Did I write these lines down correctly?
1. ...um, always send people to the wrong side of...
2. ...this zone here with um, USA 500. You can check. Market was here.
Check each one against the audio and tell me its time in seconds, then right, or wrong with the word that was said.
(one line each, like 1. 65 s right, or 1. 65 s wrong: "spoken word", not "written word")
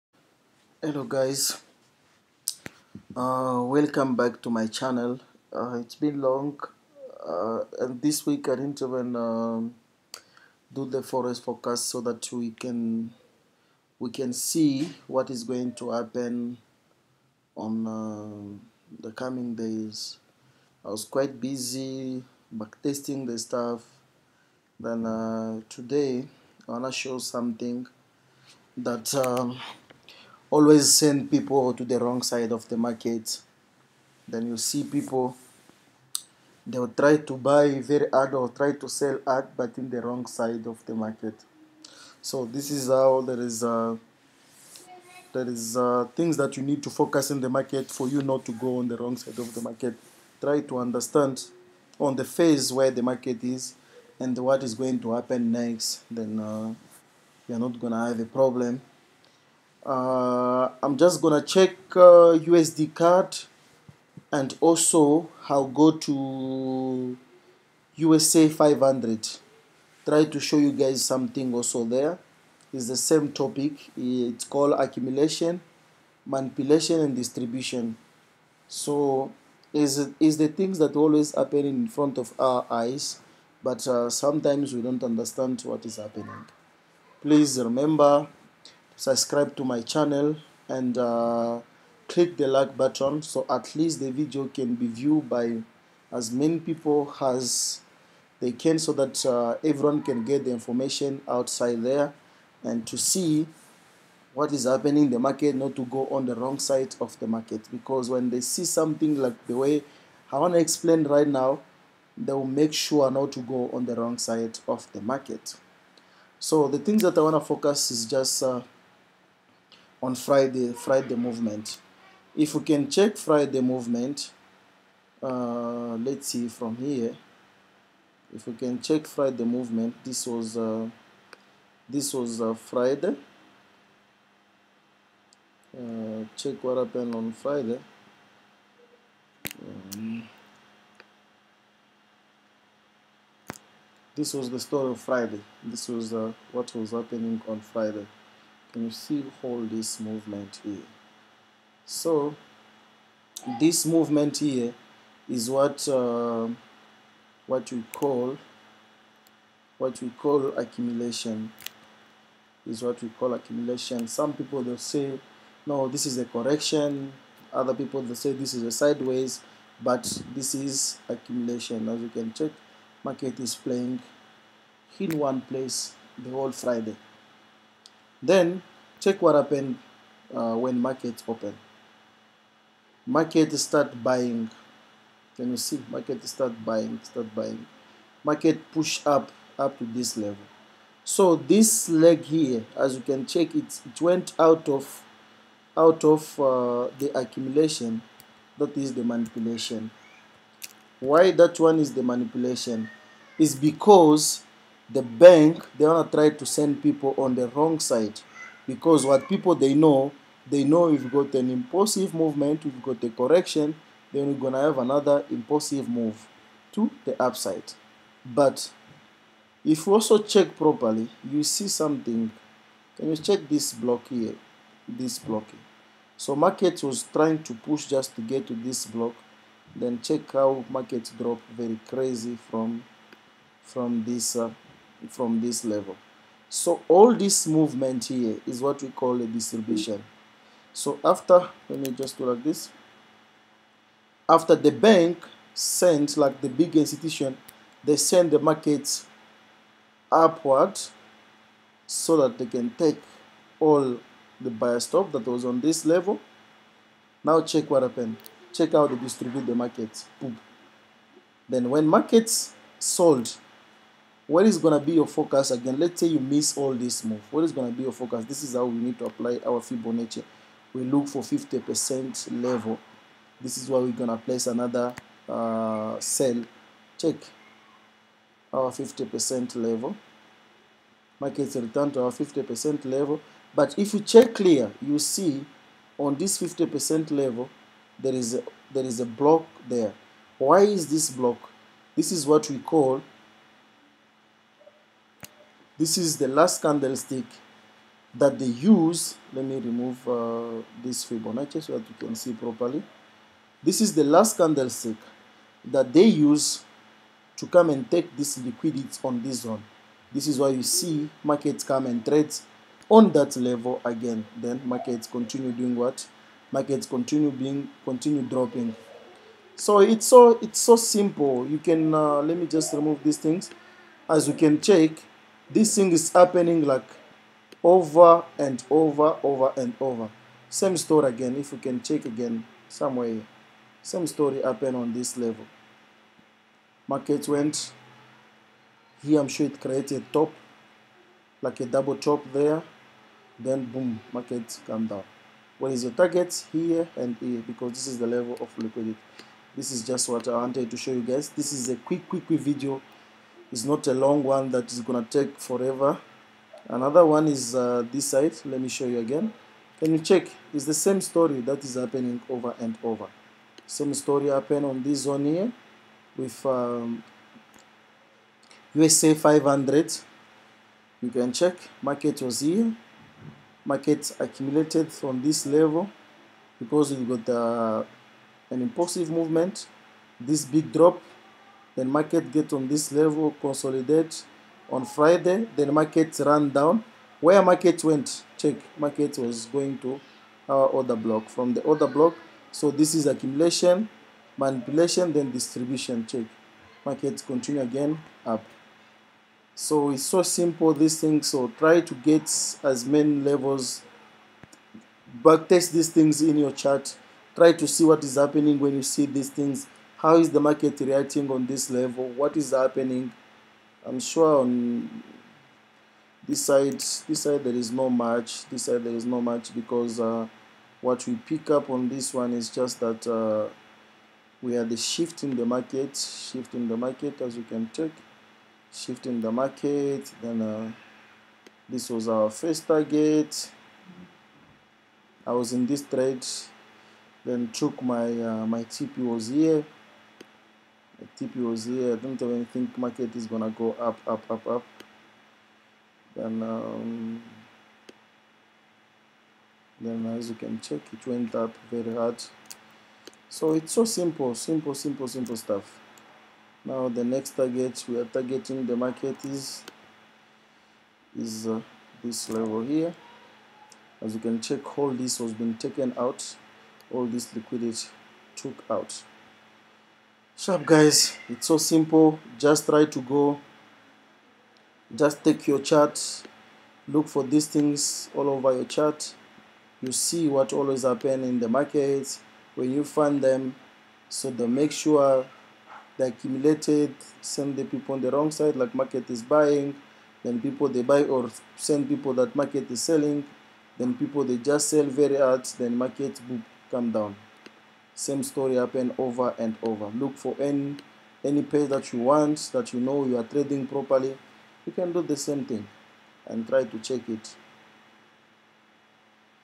1. 29 s right
2. 364 s right.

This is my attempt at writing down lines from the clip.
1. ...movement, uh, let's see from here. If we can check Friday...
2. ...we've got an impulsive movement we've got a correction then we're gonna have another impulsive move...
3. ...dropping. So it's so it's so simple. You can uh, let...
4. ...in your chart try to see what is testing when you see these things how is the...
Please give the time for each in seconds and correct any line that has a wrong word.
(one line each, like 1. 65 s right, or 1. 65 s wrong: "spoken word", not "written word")
1. 123 s right
2. 210 s right
3. 318 s right
4. 406 s wrong: "happening", not "testing".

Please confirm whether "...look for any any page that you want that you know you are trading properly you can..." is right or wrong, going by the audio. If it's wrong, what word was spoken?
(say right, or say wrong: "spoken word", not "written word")
right.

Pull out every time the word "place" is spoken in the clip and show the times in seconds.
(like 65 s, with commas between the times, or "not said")
175 s, 274 s.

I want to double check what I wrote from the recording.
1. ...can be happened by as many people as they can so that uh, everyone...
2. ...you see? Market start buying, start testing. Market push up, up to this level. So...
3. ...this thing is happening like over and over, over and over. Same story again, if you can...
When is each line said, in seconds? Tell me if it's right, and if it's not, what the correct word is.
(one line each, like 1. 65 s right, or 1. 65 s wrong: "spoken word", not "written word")
1. 94 s wrong: "viewed", not "happened"
2. 185 s wrong: "buying", not "testing"
3. 325 s right.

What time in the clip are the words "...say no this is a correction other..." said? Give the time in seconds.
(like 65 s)
164 s.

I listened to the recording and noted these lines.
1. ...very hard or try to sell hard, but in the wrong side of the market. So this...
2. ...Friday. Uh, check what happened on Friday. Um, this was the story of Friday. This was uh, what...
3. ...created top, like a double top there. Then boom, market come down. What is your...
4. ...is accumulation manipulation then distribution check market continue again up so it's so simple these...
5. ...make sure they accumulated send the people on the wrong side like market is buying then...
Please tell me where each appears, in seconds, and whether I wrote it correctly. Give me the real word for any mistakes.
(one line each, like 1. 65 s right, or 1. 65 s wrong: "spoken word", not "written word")
1. 37 s right
2. 132 s right
3. 339 s right
4. 392 s right
5. 484 s right.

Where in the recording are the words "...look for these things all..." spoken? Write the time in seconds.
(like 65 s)
476 s.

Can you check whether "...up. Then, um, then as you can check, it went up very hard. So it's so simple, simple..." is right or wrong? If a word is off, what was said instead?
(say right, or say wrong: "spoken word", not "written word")
right.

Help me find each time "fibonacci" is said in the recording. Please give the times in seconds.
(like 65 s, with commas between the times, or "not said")
269 s, 301 s.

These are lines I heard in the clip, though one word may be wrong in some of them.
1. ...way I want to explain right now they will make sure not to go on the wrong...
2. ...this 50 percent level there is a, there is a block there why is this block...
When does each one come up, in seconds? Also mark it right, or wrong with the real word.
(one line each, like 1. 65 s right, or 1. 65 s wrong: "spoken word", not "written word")
1. 109 s right
2. 286 s right.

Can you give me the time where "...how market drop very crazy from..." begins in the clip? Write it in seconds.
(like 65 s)
230 s.